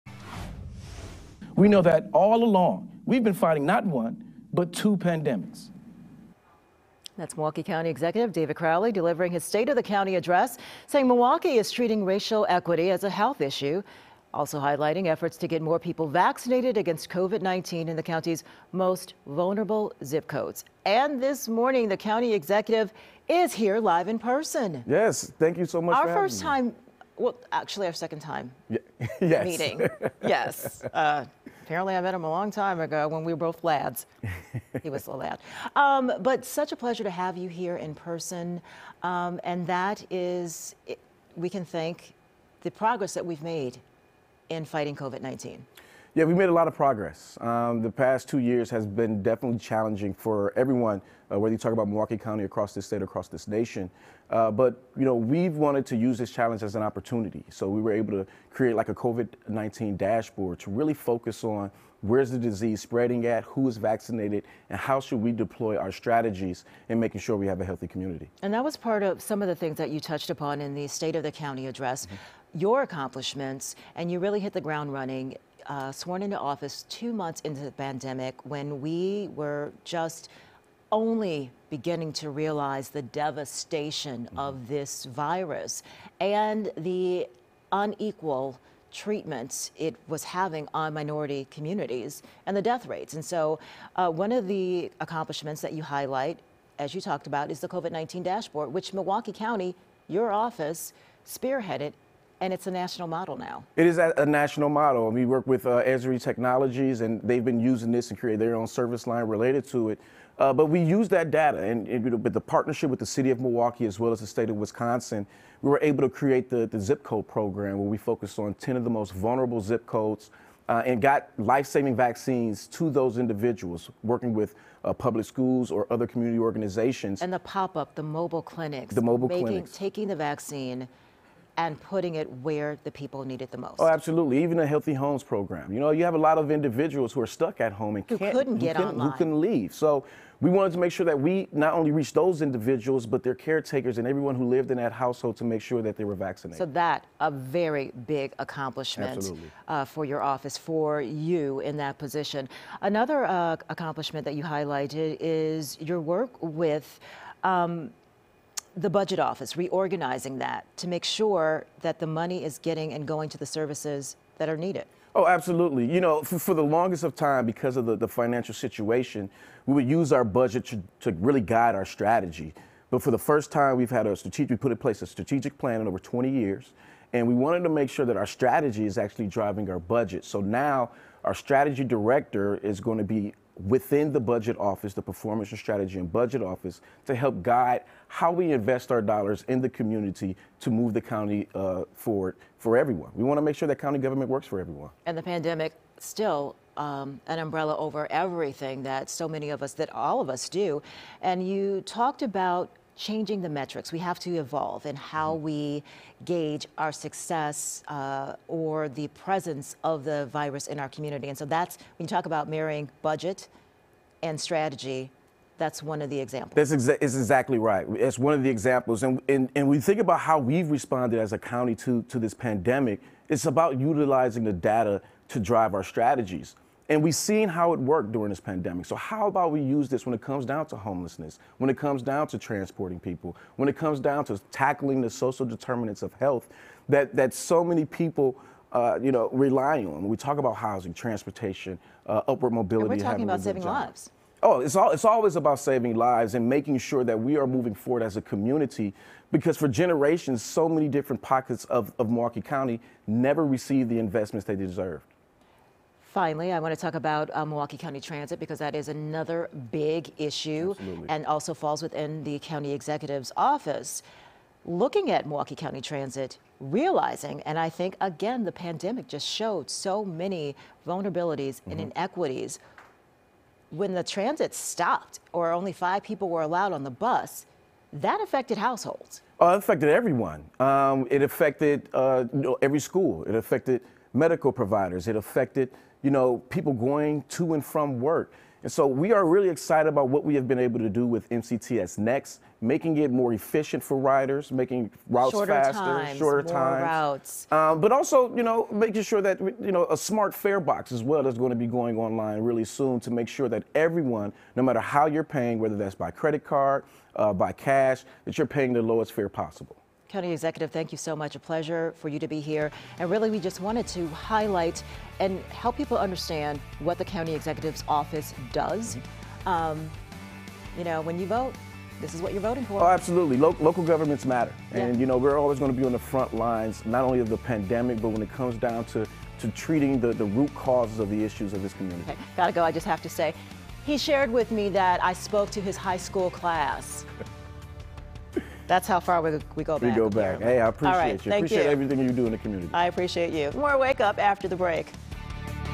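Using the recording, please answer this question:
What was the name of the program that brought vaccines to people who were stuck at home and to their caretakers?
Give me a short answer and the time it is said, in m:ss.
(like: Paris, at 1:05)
Healthy Homes, at 2:14.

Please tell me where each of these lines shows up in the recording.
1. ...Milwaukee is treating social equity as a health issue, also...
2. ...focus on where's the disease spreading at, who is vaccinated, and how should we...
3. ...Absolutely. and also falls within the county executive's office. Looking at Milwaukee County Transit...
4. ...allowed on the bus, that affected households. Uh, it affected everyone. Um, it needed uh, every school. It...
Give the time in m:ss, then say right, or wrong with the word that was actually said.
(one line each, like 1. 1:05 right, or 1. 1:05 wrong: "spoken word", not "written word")
1. 0:11 wrong: "racial", not "social"
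2. 1:00 right
3. 4:20 right
4. 4:36 wrong: "affected", not "needed".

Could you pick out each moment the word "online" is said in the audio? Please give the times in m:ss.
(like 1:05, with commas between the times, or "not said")
2:18, 5:01.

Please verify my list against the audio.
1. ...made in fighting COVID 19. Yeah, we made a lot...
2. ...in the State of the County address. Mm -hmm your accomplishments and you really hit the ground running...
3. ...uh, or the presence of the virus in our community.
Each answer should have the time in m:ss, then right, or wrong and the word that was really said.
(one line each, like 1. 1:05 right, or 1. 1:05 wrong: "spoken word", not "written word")
1. 0:43 right
2. 1:10 right
3. 3:27 right.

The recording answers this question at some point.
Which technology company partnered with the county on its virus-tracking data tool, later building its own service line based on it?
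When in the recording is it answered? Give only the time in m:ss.
1:45.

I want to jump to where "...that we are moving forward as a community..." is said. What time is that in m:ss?
4:07.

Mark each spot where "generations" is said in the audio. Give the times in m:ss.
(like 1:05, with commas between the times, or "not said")
4:09.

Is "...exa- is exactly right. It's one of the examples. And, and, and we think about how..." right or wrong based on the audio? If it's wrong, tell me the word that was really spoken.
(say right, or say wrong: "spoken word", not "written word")
right.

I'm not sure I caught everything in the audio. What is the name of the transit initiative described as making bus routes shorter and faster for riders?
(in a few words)
MCTS Next.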